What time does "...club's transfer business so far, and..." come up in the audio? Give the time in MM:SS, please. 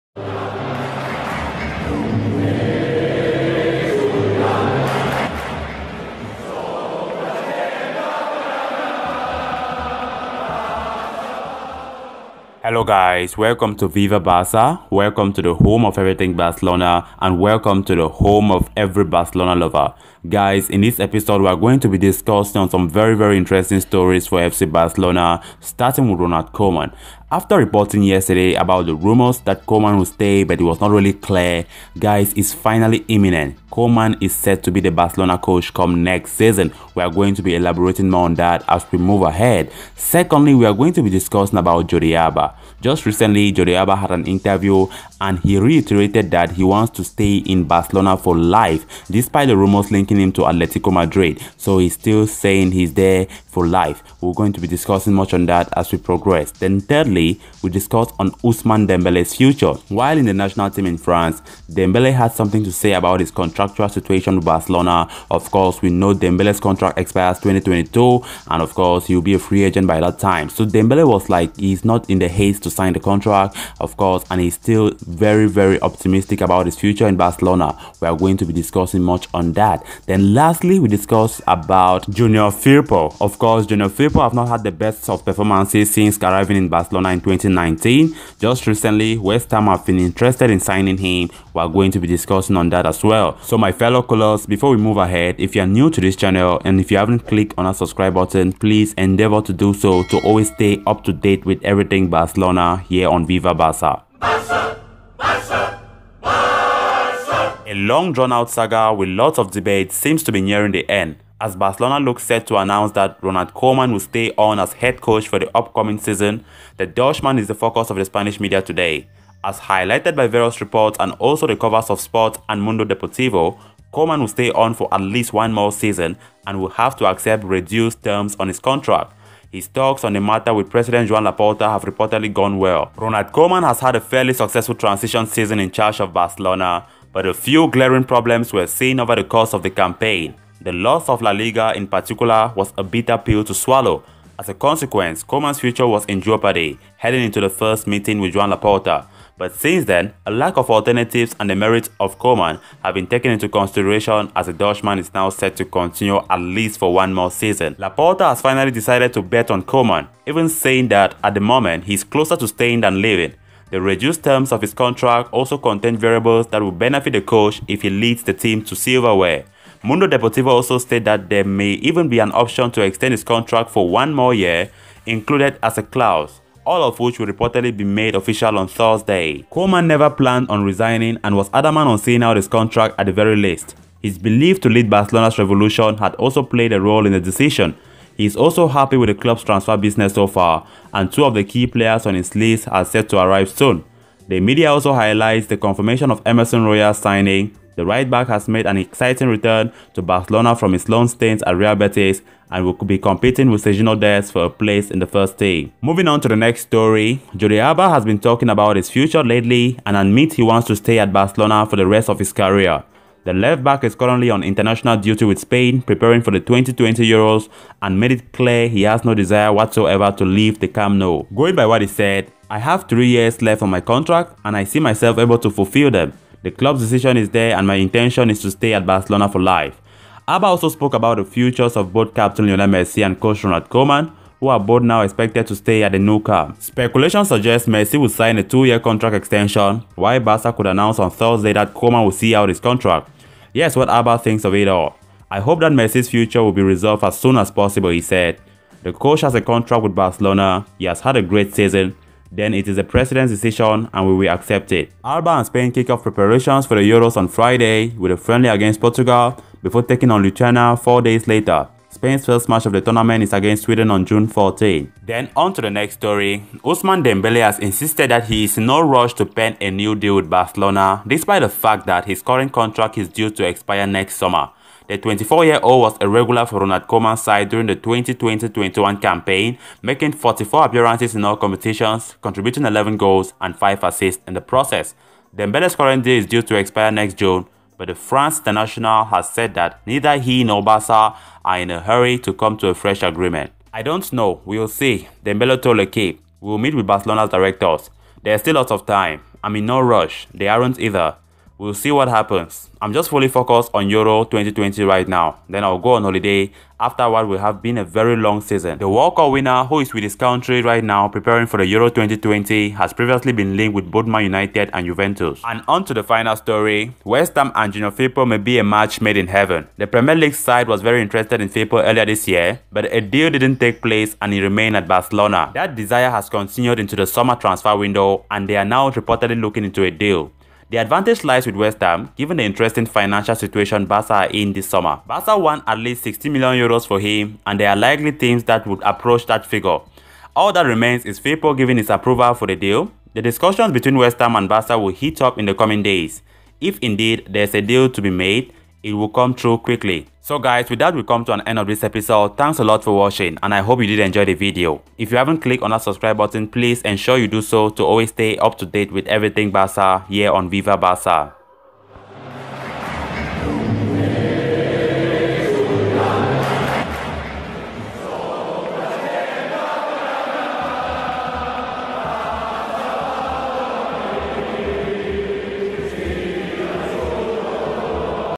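03:09.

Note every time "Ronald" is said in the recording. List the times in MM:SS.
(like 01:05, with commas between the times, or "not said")
00:26, 01:53, 02:12, 03:53, 04:36.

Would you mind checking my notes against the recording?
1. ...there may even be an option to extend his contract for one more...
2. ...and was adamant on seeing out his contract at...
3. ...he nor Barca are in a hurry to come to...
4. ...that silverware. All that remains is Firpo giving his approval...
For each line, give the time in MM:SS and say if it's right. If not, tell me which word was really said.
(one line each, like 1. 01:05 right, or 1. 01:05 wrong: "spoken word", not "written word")
1. 02:51 right
2. 03:01 right
3. 04:50 right
4. 05:39 wrong: "figure", not "silverware".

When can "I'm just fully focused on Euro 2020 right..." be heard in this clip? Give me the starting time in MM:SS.
05:02.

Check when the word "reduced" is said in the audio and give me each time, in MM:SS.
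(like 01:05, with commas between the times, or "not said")
02:07, 02:43.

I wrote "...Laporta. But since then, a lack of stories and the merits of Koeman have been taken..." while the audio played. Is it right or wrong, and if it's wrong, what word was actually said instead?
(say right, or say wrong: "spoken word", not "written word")
wrong: "alternatives", not "stories".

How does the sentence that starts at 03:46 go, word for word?
The club's decision is there and my intention is to stay at Barcelona for life.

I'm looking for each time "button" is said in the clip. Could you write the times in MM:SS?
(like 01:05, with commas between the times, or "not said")
01:38, 05:56.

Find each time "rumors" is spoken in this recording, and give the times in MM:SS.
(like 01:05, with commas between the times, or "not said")
00:28, 00:49.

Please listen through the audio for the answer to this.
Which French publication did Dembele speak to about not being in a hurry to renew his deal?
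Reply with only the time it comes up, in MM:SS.
04:55.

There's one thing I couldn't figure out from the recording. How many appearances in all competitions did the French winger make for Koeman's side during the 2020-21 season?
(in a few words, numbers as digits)
44.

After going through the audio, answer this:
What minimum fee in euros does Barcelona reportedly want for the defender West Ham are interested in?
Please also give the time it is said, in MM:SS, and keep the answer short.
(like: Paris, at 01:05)
60 million euros, at 05:36.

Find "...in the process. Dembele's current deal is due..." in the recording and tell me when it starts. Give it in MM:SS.
04:44.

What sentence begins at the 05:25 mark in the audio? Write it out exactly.
That desire has continued into the summer transfer window and they are now reportedly looking into a deal.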